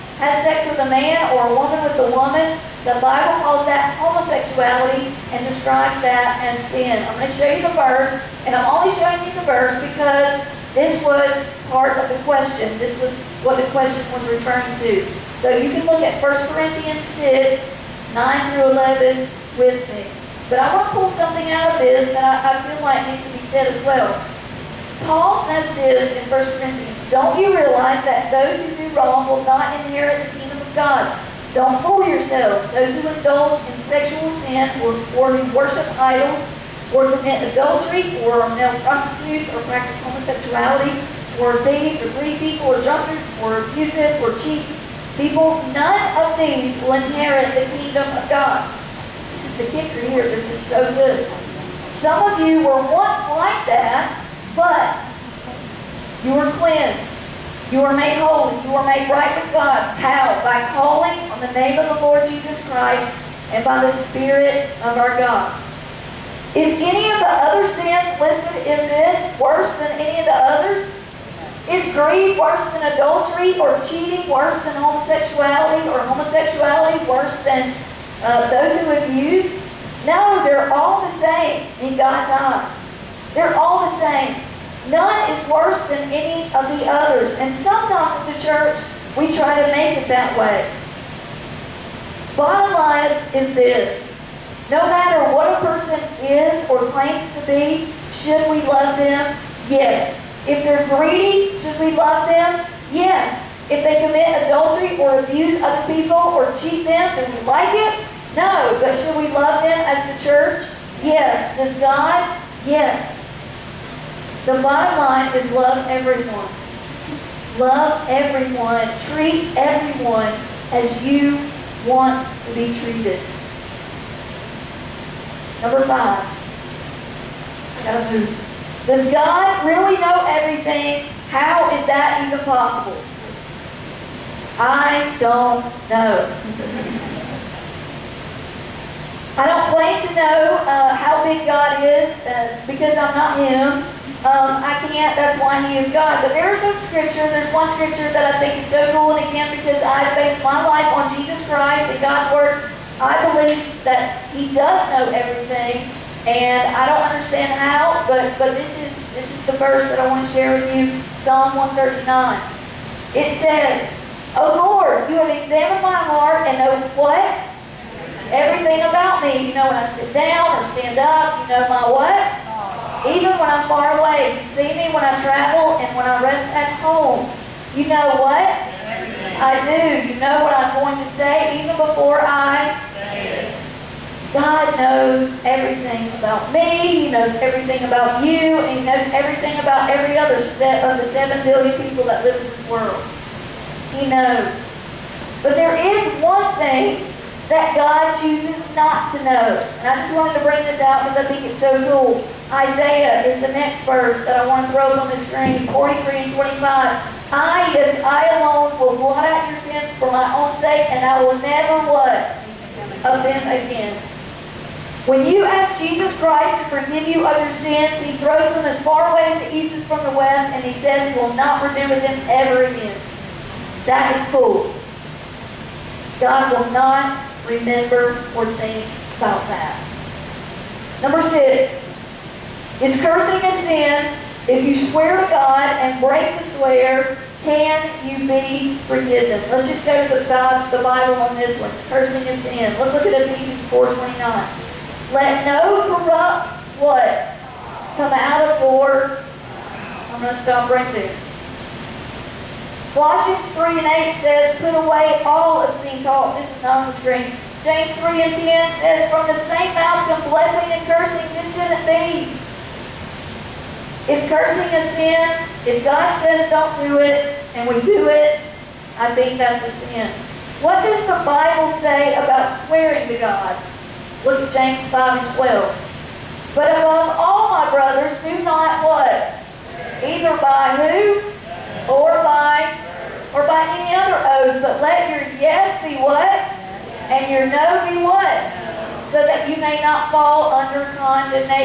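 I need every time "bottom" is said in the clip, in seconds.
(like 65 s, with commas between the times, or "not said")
92 s, 114 s.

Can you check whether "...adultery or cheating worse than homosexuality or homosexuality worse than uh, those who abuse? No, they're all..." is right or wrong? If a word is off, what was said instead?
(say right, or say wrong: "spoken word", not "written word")
right.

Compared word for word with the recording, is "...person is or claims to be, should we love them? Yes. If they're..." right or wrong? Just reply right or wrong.
right.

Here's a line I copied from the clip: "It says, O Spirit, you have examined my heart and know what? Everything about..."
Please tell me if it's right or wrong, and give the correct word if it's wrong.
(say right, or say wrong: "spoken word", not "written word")
wrong: "Lord", not "Spirit".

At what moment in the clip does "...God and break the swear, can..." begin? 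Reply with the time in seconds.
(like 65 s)
235 s.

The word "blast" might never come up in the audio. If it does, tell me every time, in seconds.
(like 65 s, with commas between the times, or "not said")
not said.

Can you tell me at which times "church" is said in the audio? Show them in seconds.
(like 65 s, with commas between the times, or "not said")
88 s, 110 s.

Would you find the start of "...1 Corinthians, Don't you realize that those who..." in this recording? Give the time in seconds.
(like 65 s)
26 s.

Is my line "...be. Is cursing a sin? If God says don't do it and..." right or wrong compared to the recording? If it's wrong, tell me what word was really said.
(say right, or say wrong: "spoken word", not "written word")
right.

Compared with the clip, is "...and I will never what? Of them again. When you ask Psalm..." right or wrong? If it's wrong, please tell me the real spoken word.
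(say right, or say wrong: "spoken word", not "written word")
wrong: "Jesus", not "Psalm".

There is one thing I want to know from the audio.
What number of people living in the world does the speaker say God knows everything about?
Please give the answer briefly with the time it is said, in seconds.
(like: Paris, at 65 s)
7 billion, at 191 s.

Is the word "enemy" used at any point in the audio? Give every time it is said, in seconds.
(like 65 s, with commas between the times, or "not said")
not said.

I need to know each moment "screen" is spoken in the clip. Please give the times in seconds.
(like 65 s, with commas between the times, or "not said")
205 s, 256 s.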